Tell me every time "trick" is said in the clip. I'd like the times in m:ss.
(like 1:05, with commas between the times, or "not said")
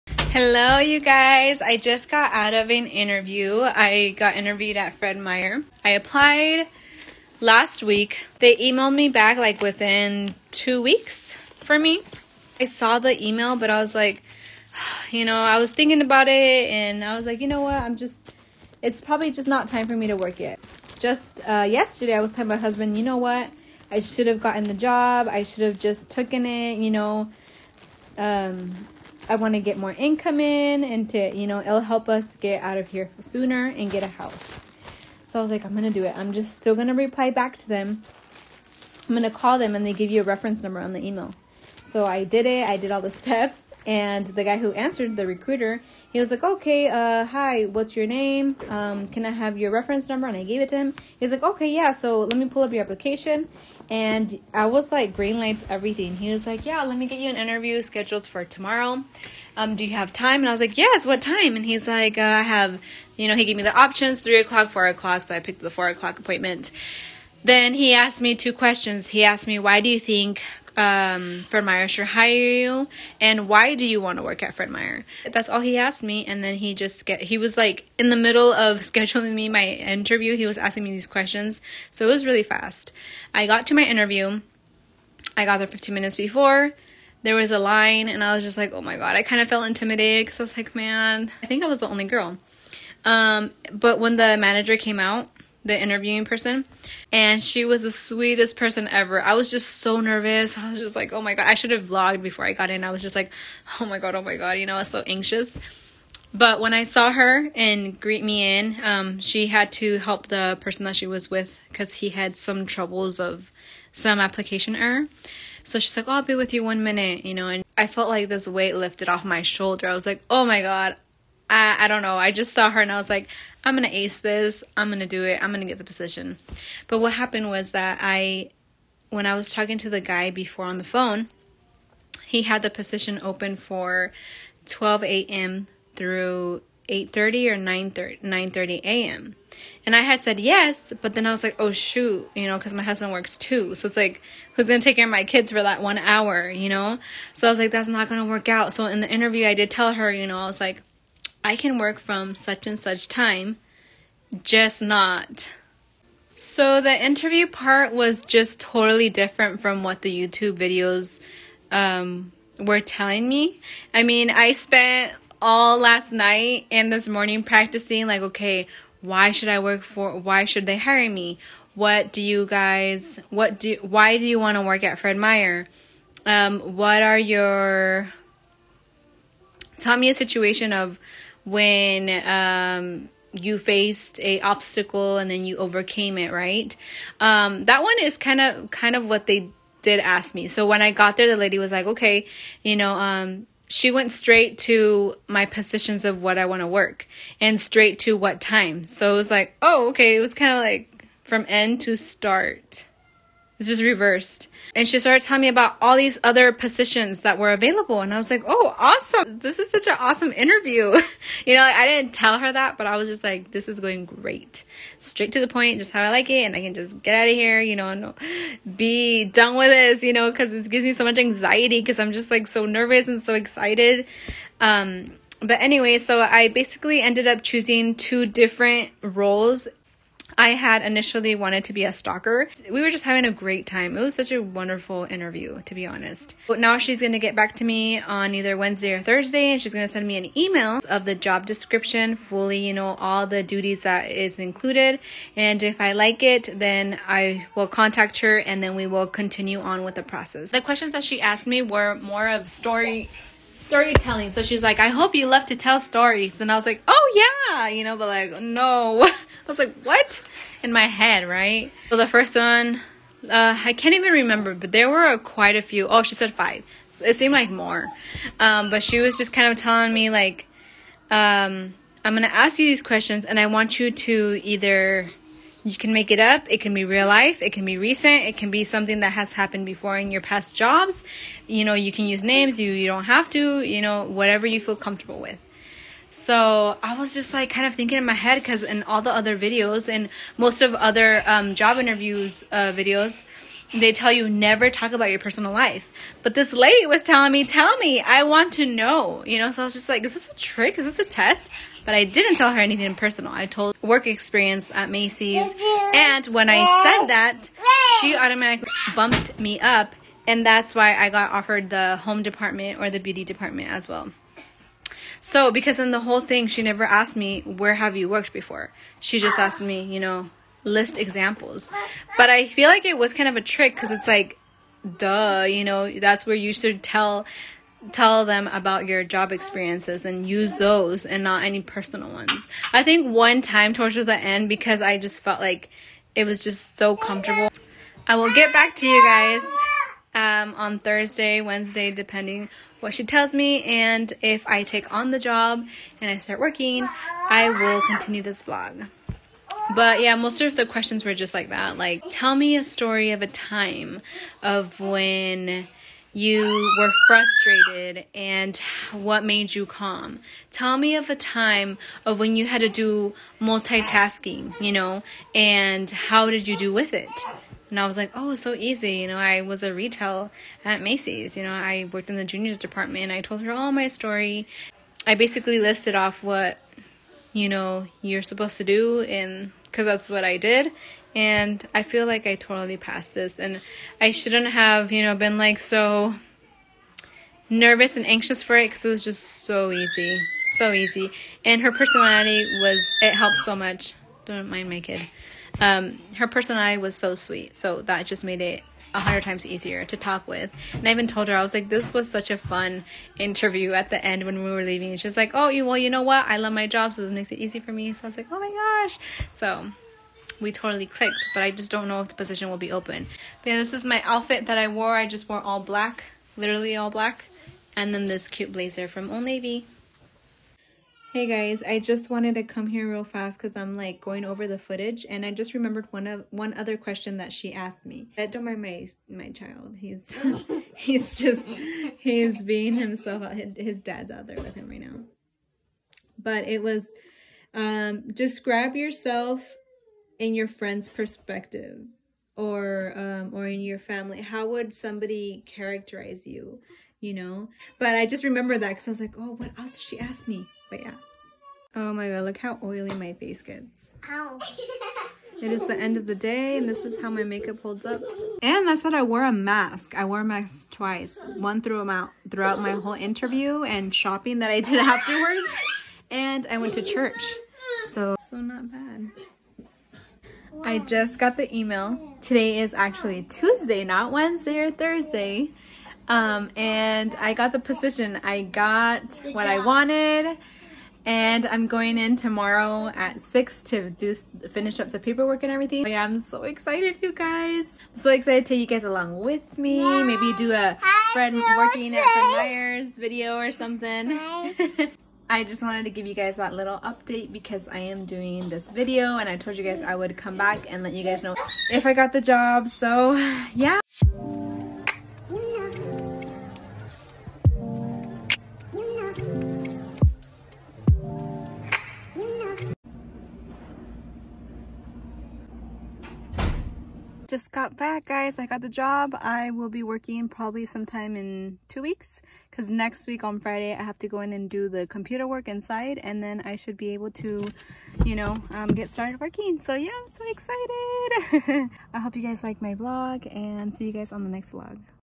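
5:00, 5:23.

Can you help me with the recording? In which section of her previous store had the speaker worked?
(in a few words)
Juniors department.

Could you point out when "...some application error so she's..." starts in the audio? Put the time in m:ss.
1:53.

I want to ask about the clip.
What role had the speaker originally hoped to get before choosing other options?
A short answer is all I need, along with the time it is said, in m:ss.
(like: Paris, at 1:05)
Stocker, at 3:51.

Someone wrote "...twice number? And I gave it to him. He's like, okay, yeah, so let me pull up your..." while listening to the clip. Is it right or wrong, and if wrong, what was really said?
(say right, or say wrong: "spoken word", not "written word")
wrong: "reference", not "twice".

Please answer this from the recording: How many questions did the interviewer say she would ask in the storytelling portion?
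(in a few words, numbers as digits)
5.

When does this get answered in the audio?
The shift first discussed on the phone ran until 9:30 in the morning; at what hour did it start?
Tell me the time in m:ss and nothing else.
2:14.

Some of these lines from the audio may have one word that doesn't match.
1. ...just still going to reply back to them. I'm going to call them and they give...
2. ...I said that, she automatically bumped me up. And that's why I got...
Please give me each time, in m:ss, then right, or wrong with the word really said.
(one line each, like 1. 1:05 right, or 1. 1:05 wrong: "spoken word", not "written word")
1. 0:36 right
2. 5:06 right.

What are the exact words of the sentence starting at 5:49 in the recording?
But yeah, most of the questions were just like that.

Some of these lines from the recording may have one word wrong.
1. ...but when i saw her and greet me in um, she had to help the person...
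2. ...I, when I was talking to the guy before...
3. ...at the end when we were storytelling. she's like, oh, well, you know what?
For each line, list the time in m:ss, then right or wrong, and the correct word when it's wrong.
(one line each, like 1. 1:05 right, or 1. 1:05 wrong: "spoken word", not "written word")
1. 1:46 right
2. 2:08 right
3. 6:43 wrong: "leaving", not "storytelling".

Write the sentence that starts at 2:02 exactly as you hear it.
I just saw her and I was like, I'm going to ace this.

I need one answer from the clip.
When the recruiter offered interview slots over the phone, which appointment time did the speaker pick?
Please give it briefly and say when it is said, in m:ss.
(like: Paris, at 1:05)
4 o'clock, at 1:05.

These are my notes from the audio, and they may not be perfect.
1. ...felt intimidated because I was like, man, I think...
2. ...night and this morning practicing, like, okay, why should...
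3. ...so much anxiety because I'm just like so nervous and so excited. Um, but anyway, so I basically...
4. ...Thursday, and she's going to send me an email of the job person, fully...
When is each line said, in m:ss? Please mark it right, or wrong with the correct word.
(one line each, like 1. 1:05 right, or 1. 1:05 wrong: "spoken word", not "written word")
1. 1:29 right
2. 2:46 right
3. 3:40 right
4. 3:59 wrong: "description", not "person".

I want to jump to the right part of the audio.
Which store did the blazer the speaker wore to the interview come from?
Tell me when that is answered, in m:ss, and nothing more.
6:59.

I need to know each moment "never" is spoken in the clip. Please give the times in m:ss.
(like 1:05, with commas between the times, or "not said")
4:54, 5:16.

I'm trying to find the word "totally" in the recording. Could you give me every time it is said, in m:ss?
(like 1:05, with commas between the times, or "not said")
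2:38, 6:22, 6:50.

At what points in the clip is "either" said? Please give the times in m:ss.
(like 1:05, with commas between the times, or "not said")
3:58, 4:34.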